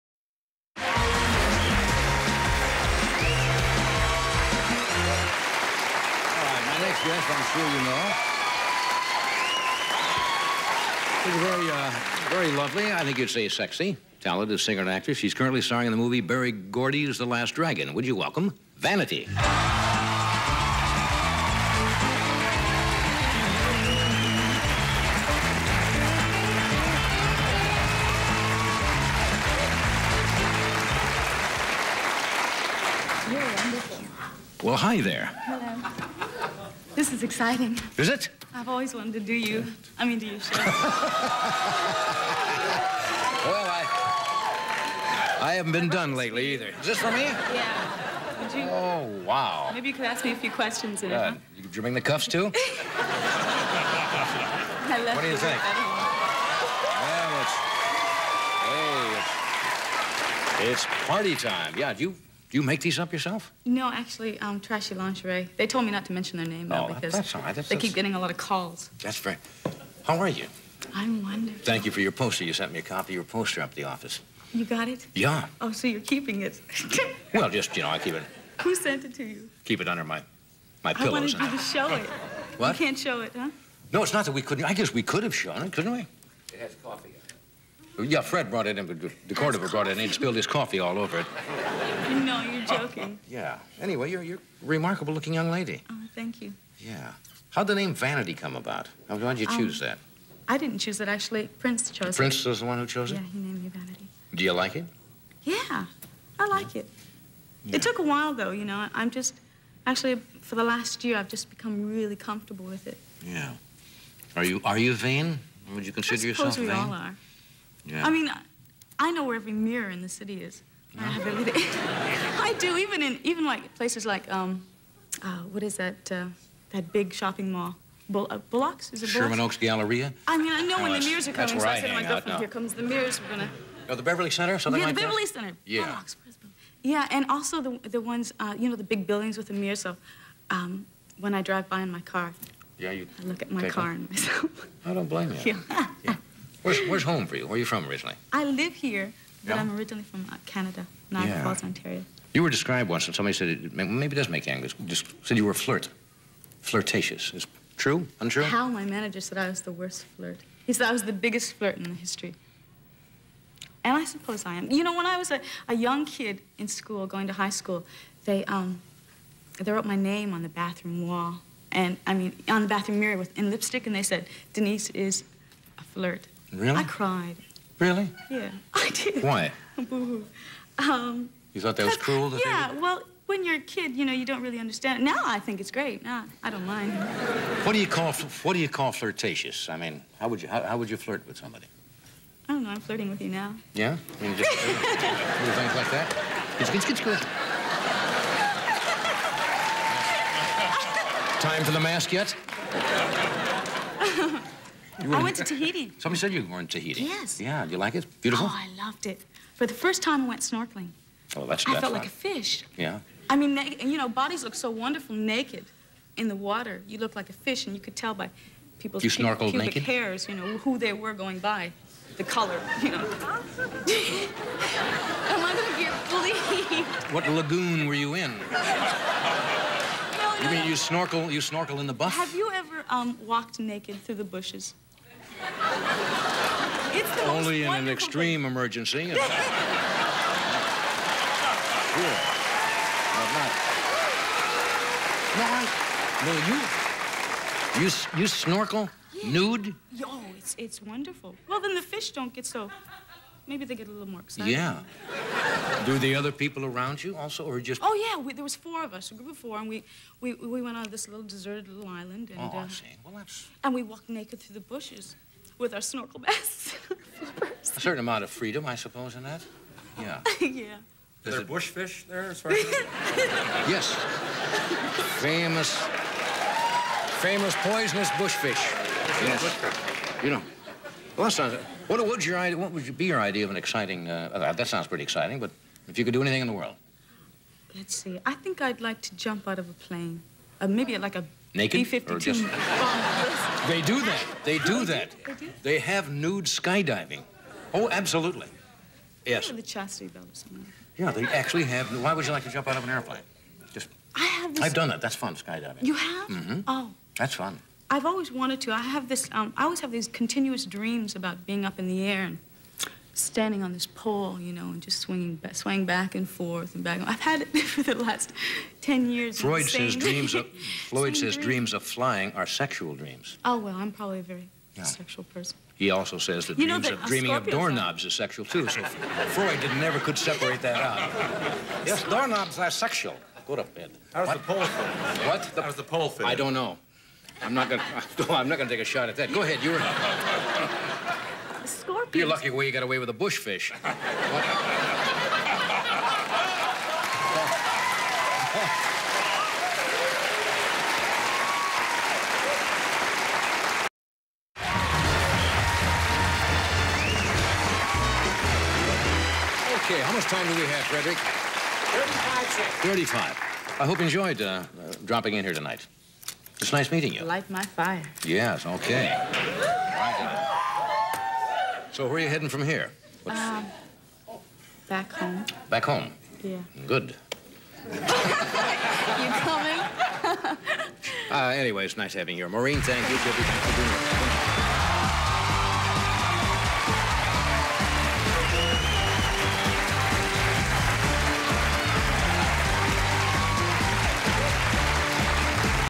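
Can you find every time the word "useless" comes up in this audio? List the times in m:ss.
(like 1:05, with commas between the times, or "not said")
not said.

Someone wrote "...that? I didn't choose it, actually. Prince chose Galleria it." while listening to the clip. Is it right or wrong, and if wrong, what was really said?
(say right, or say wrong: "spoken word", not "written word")
wrong: "Prince", not "Galleria".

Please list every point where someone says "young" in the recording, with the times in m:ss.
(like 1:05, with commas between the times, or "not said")
1:35, 2:45.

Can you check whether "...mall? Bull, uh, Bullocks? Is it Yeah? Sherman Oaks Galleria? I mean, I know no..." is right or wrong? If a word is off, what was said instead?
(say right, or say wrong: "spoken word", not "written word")
wrong: "Bullocks", not "Yeah".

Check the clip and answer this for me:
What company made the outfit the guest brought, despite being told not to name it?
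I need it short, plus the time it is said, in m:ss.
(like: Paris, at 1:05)
Trashy Lingerie, at 1:04.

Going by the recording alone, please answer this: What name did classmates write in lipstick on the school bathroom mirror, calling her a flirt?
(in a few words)
Denise.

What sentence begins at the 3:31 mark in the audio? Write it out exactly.
Oh, that's I felt like a fish.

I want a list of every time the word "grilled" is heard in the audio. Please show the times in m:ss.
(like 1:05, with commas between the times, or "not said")
not said.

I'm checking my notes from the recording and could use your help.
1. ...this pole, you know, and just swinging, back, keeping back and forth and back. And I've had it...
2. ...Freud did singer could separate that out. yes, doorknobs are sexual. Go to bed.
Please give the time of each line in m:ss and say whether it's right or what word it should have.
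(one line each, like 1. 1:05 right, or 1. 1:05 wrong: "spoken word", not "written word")
1. 5:13 wrong: "swaying", not "keeping"
2. 5:28 wrong: "never", not "singer".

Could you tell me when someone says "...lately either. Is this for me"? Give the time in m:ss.
0:46.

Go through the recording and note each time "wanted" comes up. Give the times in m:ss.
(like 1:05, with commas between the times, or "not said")
0:38, 1:21, 5:08.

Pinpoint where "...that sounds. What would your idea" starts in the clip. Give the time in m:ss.
4:41.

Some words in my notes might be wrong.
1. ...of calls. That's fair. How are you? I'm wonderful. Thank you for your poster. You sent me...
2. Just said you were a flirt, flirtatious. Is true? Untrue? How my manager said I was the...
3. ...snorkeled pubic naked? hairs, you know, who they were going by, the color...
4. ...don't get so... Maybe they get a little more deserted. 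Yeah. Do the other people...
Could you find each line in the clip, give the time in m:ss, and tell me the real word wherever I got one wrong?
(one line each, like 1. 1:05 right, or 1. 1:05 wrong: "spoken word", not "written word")
1. 1:08 right
2. 2:34 right
3. 3:39 right
4. 4:12 wrong: "excited", not "deserted".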